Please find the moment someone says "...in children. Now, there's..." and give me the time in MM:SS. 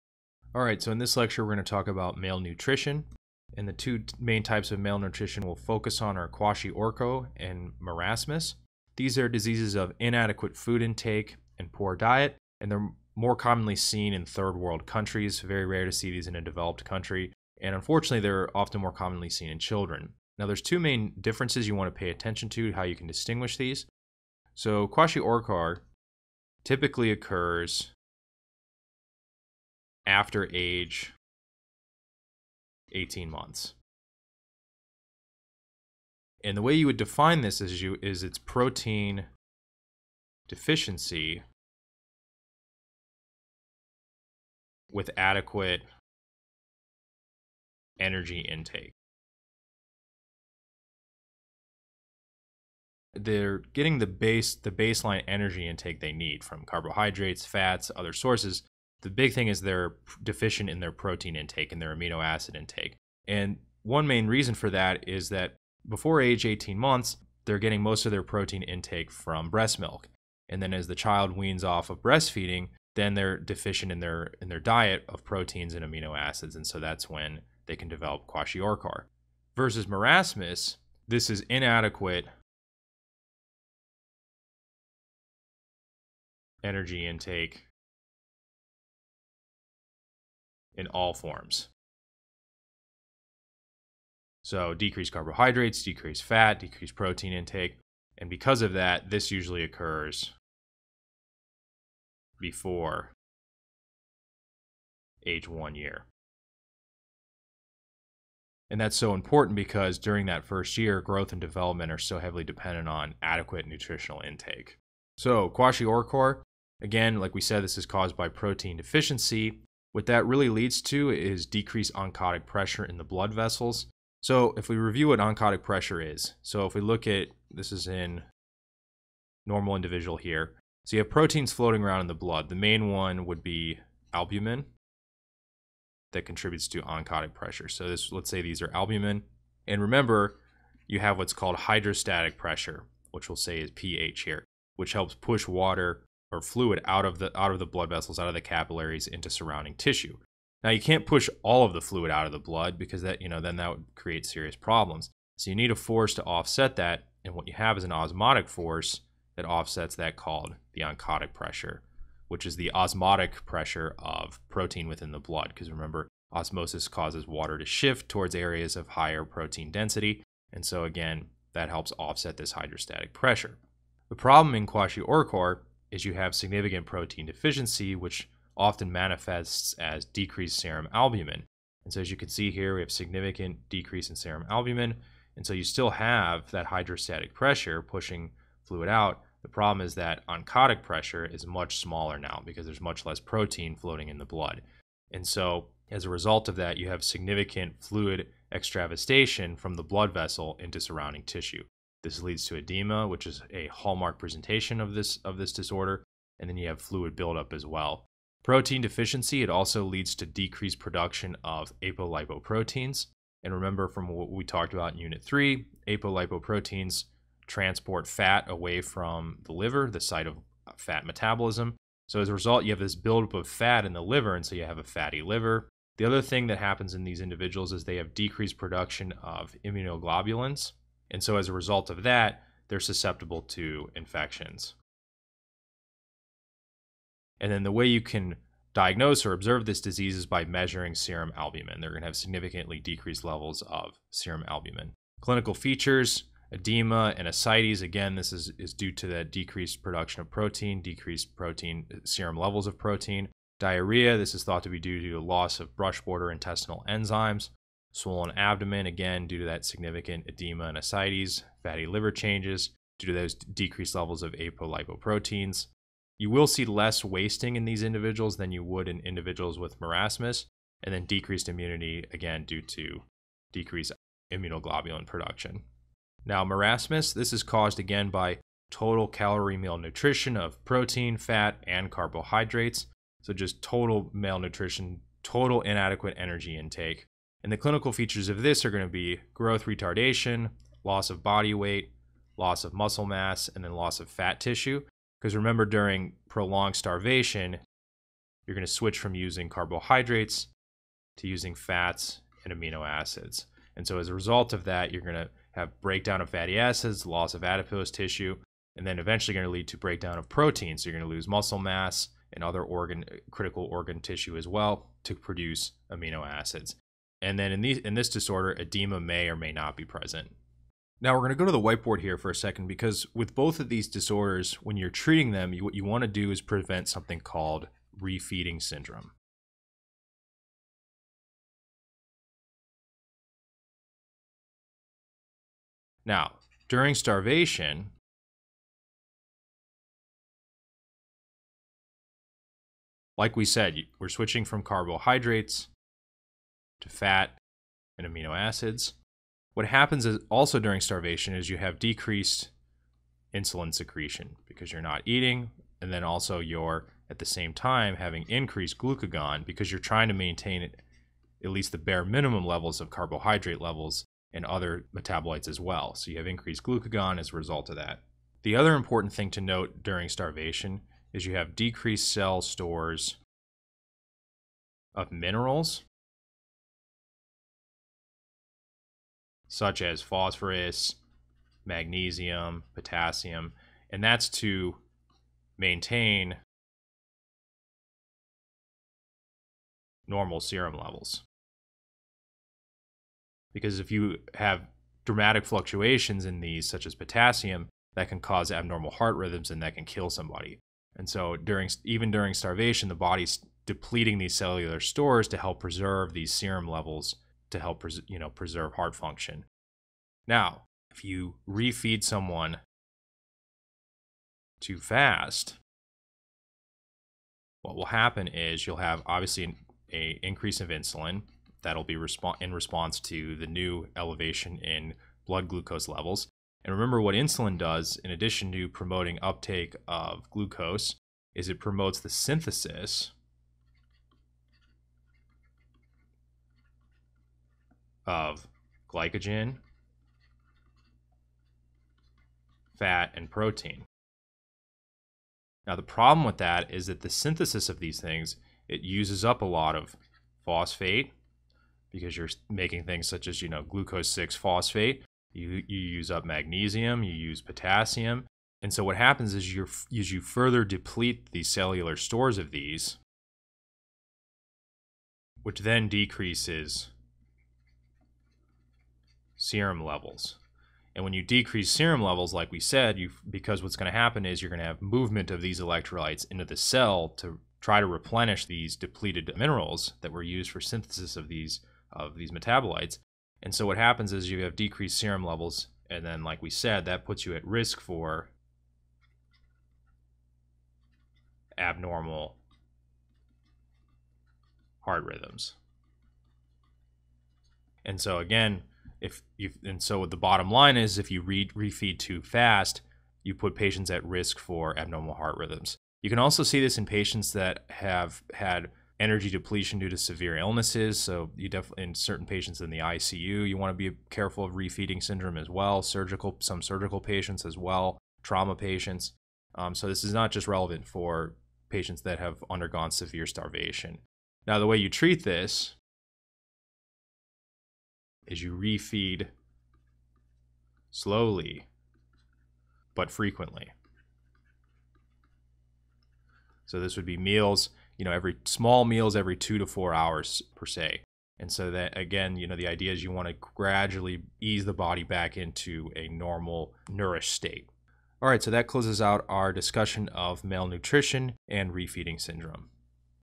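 00:19.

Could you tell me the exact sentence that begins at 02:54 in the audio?
The problem in kwashiorkor is you have significant protein deficiency, which often manifests as decreased serum albumin.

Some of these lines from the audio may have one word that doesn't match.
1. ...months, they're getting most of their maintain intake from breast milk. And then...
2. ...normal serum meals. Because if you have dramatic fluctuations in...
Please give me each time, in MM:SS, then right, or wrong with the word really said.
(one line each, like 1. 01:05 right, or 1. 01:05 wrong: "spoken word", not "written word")
1. 01:06 wrong: "protein", not "maintain"
2. 06:30 wrong: "levels", not "meals".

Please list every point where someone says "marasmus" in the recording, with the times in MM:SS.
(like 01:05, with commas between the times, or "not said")
00:07, 01:19, 04:29, 04:36.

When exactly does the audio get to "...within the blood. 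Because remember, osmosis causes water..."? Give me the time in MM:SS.
02:44.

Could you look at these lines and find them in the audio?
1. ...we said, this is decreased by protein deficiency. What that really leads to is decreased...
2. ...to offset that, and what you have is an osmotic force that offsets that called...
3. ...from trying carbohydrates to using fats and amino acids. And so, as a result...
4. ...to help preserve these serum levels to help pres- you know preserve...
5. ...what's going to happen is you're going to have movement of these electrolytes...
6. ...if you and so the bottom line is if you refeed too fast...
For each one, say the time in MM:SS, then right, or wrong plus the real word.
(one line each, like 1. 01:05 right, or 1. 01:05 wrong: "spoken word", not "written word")
1. 01:57 wrong: "caused", not "decreased"
2. 02:36 right
3. 04:58 wrong: "using", not "trying"
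4. 06:45 right
5. 07:53 right
6. 08:19 right.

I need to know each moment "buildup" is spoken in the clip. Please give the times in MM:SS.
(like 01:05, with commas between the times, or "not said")
03:27, 03:42.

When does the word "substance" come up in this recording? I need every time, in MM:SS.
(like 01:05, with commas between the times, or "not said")
not said.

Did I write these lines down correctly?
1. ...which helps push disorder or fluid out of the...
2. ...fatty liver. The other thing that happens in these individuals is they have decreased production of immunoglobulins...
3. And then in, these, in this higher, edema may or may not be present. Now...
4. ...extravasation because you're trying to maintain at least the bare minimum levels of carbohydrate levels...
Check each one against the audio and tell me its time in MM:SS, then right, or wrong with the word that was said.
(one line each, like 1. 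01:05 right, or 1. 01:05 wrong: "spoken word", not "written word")
1. 02:24 wrong: "water", not "disorder"
2. 03:44 right
3. 05:17 wrong: "disorder", not "higher"
4. 05:58 wrong: "glucagon", not "extravasation".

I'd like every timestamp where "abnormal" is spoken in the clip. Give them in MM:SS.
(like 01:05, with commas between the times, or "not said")
06:38, 08:11, 08:24.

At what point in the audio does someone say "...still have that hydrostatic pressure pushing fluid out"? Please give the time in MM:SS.
03:05.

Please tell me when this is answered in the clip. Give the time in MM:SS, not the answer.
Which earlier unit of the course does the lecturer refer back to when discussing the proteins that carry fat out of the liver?
03:34.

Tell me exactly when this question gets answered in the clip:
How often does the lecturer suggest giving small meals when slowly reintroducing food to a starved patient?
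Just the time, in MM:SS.
08:59.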